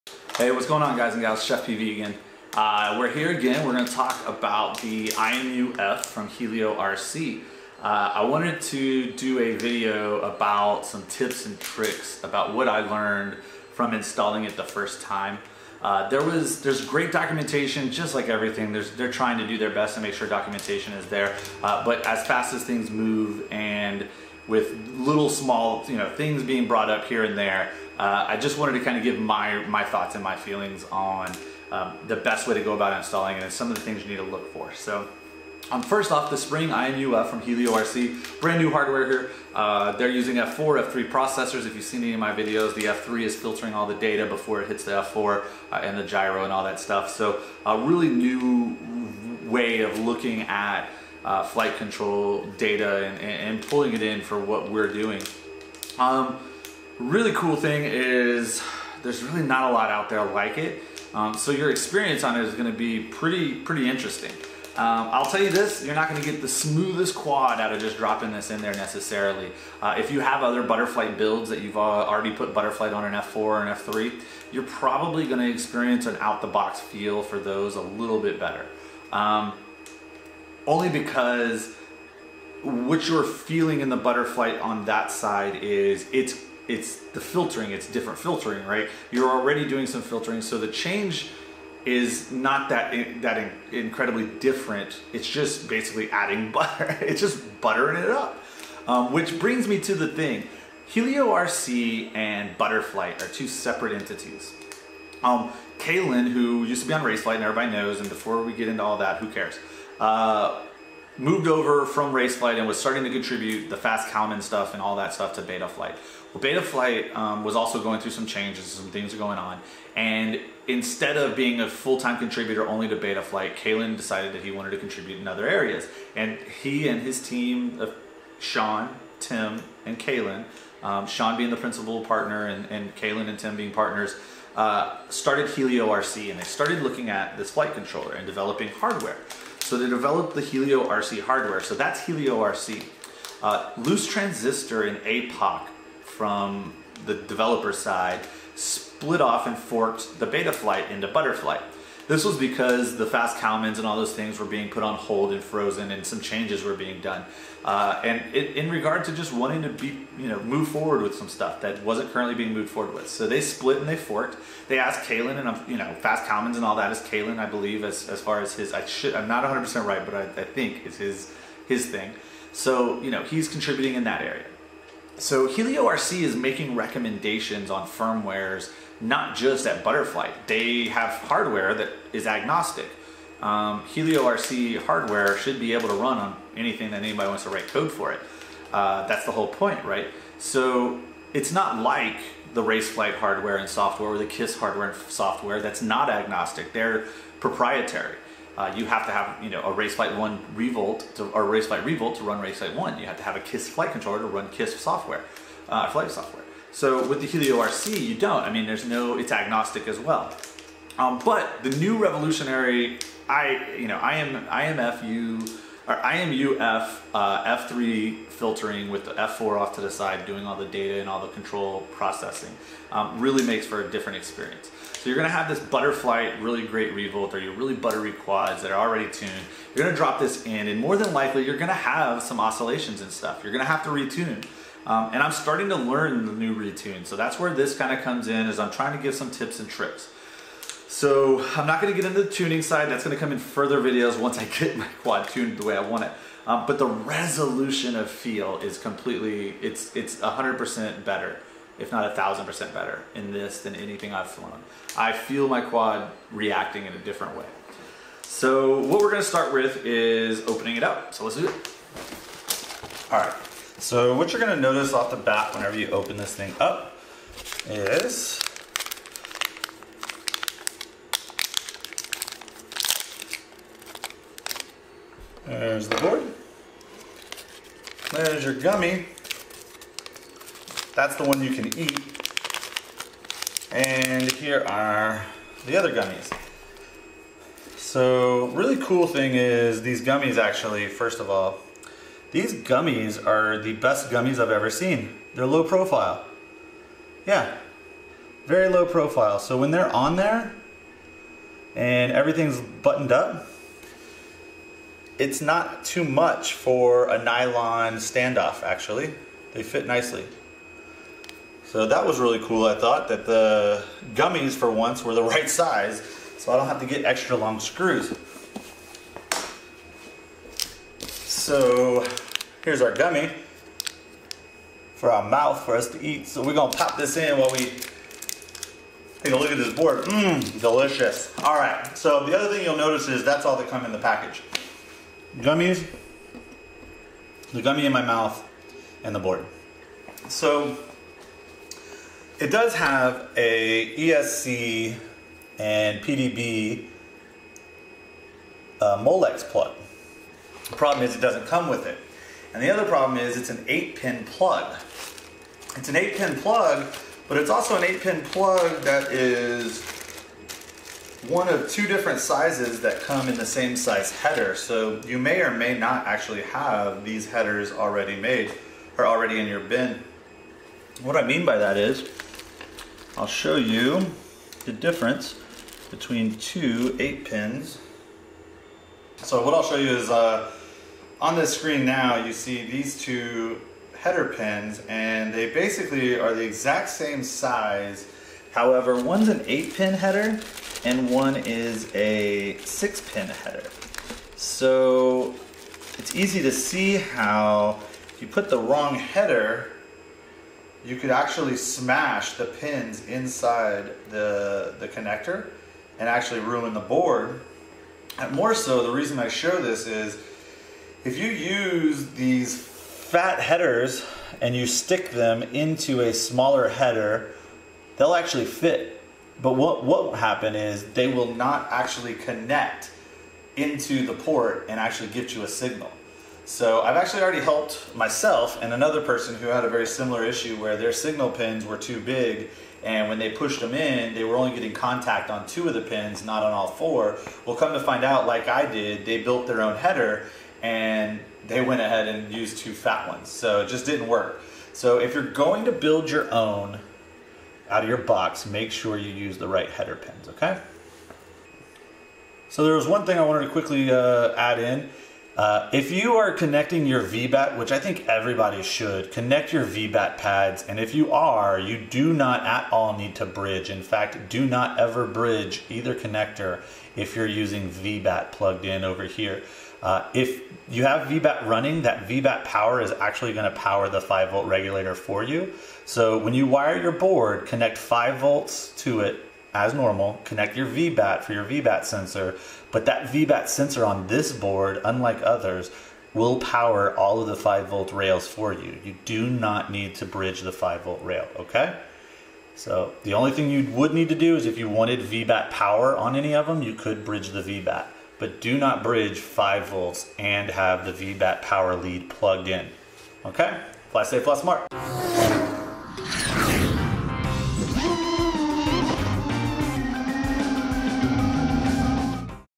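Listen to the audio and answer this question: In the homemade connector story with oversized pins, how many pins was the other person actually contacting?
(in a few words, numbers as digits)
2.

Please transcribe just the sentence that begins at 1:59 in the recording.
And instead of being a full-time contributor only to beta flight, Kalyn decided that he wanted to contribute in other areas.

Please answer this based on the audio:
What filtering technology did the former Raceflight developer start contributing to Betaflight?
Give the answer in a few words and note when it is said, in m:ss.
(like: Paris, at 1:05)
Fast Kalman, at 1:53.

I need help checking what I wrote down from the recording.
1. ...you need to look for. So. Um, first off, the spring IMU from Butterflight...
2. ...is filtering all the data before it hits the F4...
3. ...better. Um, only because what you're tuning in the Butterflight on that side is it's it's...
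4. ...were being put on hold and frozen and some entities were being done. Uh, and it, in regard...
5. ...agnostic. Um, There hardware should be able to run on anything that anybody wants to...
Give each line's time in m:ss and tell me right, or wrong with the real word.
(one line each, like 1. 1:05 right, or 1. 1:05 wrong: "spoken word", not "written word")
1. 0:34 wrong: "Helio", not "Butterflight"
2. 0:43 right
3. 1:18 wrong: "feeling", not "tuning"
4. 2:34 wrong: "changes", not "entities"
5. 3:02 wrong: "HelioRC", not "There".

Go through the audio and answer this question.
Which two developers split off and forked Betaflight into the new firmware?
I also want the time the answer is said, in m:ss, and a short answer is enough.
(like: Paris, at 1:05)
Loose transistor and APOC, at 2:23.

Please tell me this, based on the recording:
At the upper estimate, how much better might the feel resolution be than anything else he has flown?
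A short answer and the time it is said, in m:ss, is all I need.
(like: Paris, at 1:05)
1,000%, at 4:12.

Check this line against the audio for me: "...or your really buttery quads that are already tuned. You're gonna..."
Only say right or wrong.
right.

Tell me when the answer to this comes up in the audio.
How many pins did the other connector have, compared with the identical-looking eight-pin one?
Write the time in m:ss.
6:32.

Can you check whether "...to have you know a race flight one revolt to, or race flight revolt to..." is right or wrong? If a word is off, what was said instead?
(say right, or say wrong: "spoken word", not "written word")
right.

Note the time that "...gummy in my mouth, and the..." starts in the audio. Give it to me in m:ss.
5:37.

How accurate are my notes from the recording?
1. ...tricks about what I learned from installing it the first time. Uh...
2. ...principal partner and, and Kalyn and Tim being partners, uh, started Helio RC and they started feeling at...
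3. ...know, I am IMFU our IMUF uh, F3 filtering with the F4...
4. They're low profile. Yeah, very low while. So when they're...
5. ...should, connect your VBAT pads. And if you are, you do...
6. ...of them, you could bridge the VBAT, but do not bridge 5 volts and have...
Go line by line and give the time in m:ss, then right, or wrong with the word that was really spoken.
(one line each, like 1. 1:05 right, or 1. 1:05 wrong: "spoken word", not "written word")
1. 0:11 right
2. 2:11 wrong: "looking", not "feeling"
3. 3:33 right
4. 4:55 wrong: "profile", not "while"
5. 7:38 right
6. 8:16 right.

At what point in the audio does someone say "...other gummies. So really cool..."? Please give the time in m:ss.
4:45.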